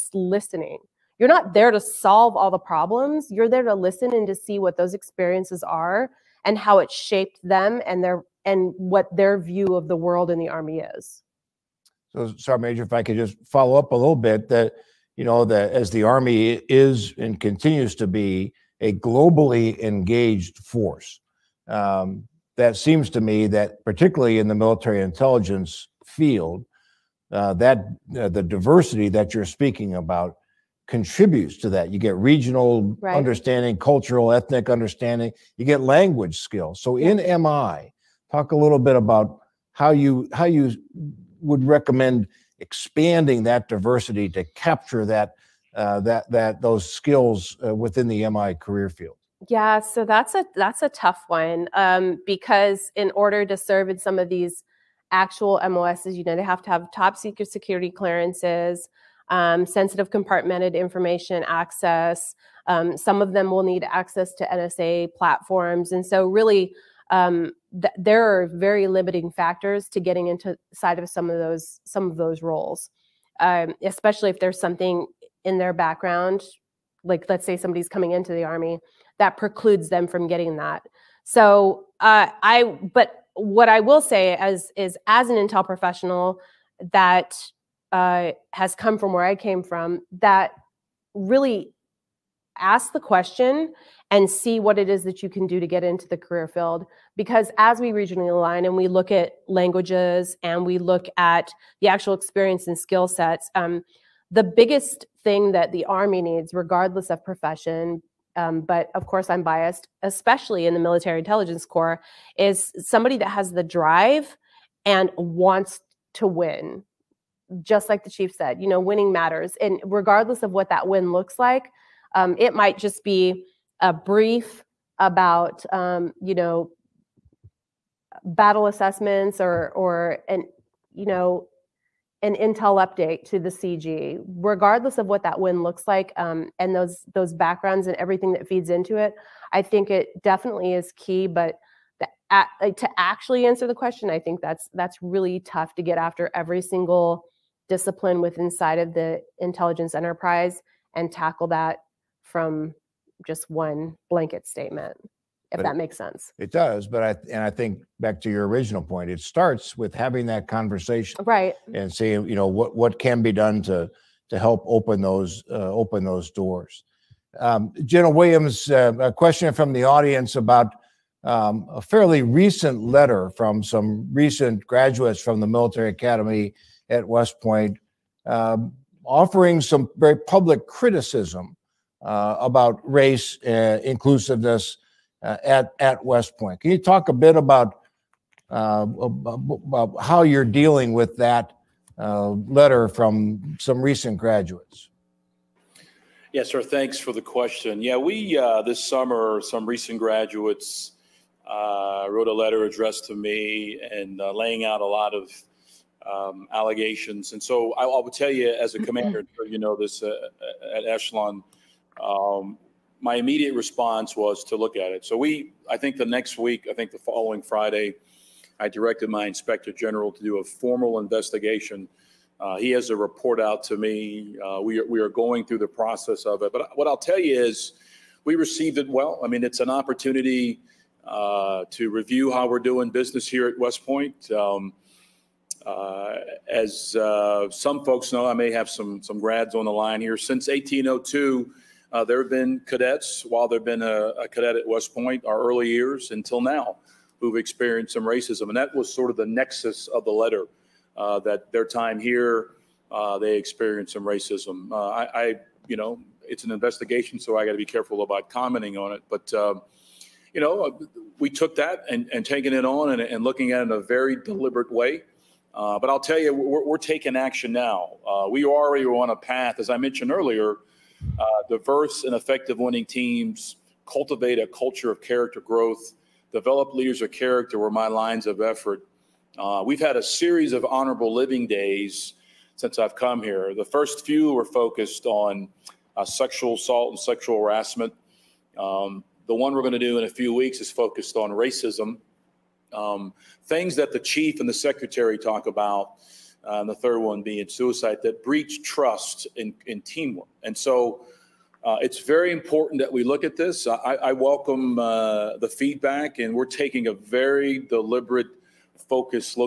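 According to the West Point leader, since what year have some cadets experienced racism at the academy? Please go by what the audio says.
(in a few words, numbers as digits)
1802.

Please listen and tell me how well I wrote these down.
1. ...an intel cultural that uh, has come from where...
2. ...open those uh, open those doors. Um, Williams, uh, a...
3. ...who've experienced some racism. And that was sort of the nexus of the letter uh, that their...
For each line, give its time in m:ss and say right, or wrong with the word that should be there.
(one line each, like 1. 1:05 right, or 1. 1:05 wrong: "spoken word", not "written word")
1. 1:25 wrong: "professional", not "cultural"
2. 2:44 right
3. 4:07 right.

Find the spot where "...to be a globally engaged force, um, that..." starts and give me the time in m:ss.
0:17.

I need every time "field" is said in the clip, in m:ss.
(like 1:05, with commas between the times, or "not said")
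0:26, 0:48, 1:36.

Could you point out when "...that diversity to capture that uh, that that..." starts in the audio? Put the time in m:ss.
0:43.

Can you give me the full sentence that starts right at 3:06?
Can you talk a bit about, about how you're dealing with that letter from some recent graduates?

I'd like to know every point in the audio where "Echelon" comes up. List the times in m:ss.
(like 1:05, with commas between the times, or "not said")
3:30.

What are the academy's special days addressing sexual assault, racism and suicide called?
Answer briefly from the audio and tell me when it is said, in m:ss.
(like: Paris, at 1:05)
Honorable living days, at 4:40.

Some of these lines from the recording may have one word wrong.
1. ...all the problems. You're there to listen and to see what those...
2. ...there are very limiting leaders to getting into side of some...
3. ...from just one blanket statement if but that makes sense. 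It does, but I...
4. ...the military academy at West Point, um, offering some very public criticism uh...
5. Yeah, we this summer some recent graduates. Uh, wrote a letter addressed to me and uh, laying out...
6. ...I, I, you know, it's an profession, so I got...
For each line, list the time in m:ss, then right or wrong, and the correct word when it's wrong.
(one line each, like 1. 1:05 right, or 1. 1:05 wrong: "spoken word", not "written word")
1. 0:02 right
2. 1:07 wrong: "factors", not "leaders"
3. 2:32 right
4. 2:55 right
5. 3:17 right
6. 4:14 wrong: "investigation", not "profession".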